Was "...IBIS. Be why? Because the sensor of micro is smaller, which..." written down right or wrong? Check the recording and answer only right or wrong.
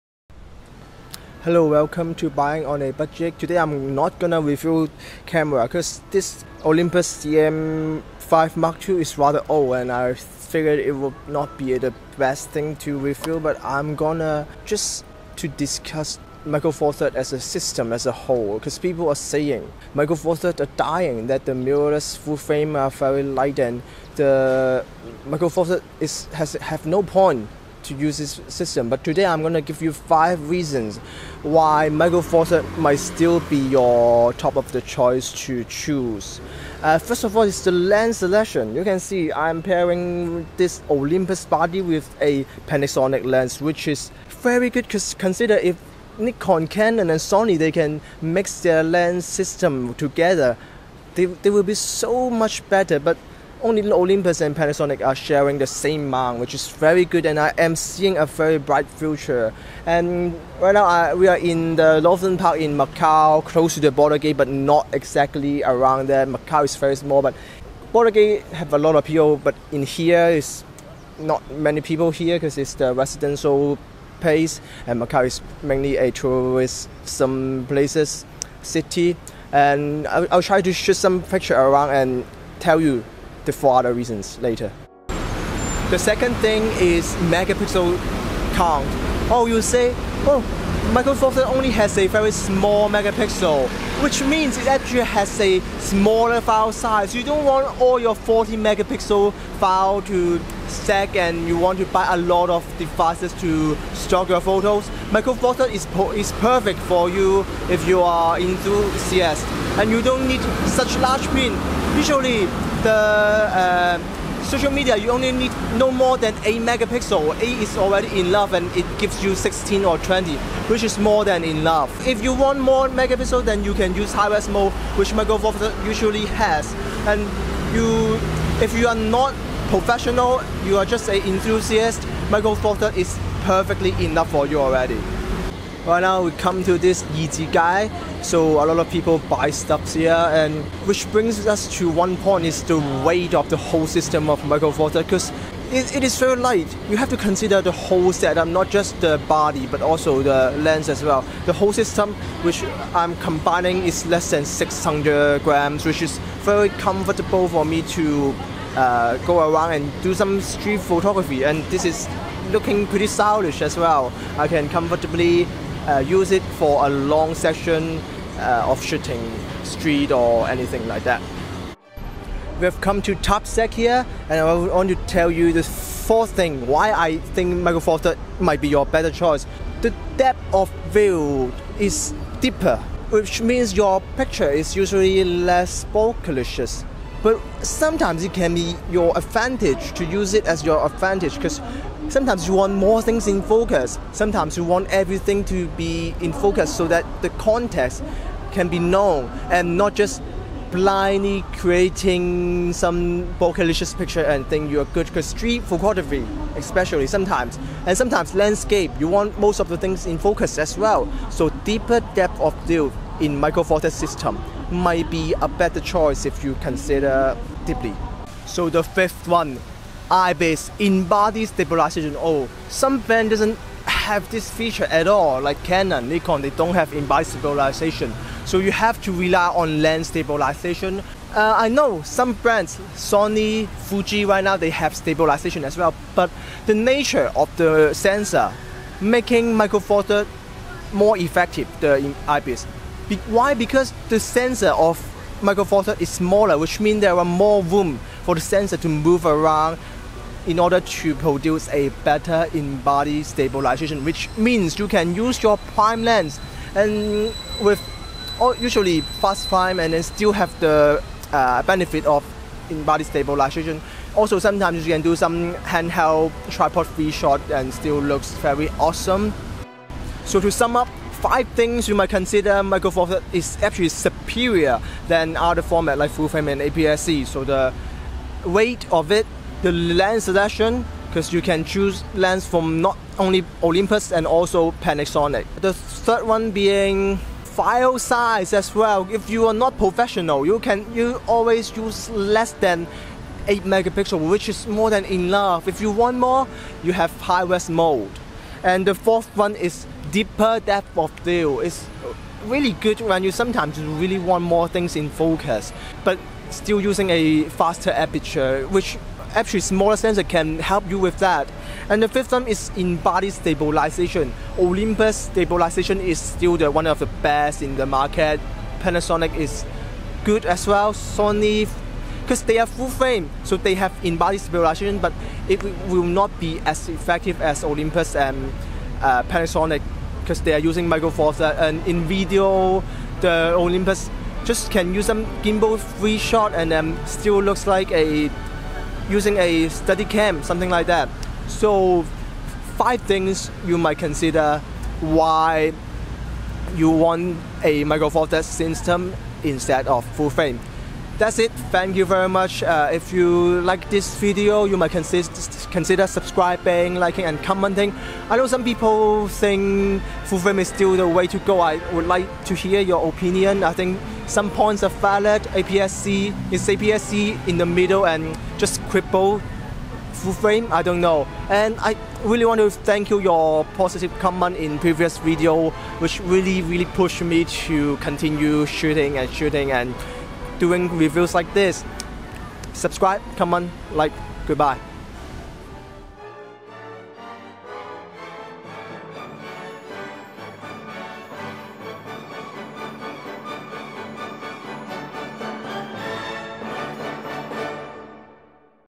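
right.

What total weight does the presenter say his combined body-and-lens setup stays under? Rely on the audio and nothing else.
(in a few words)
600 grams.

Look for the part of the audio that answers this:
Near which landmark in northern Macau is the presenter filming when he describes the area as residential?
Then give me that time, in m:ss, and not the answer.
1:03.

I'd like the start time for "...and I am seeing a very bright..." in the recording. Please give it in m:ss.
0:57.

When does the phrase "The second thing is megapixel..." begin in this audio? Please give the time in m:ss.
1:25.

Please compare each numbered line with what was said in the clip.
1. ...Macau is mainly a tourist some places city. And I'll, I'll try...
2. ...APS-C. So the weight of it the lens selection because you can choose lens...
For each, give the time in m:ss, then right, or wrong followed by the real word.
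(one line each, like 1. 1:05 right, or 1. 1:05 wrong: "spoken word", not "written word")
1. 1:15 right
2. 4:36 right.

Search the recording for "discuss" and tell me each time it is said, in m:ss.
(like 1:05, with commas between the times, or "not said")
0:15.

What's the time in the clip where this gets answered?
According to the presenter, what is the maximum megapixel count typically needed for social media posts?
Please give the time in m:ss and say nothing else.
1:55.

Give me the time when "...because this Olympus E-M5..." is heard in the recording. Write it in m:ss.
0:05.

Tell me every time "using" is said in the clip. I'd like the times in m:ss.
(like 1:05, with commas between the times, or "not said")
5:06, 5:30, 5:39.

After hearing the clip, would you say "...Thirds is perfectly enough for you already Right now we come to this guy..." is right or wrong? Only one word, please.
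right.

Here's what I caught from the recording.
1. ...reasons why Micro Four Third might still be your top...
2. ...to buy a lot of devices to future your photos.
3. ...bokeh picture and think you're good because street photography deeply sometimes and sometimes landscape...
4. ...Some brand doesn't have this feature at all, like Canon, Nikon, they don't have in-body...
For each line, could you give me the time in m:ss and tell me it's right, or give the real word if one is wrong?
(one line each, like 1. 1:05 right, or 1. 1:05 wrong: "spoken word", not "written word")
1. 0:30 right
2. 1:41 wrong: "store", not "future"
3. 3:23 wrong: "especially", not "deeply"
4. 3:42 right.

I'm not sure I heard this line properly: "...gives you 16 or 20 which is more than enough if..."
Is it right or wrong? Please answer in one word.
right.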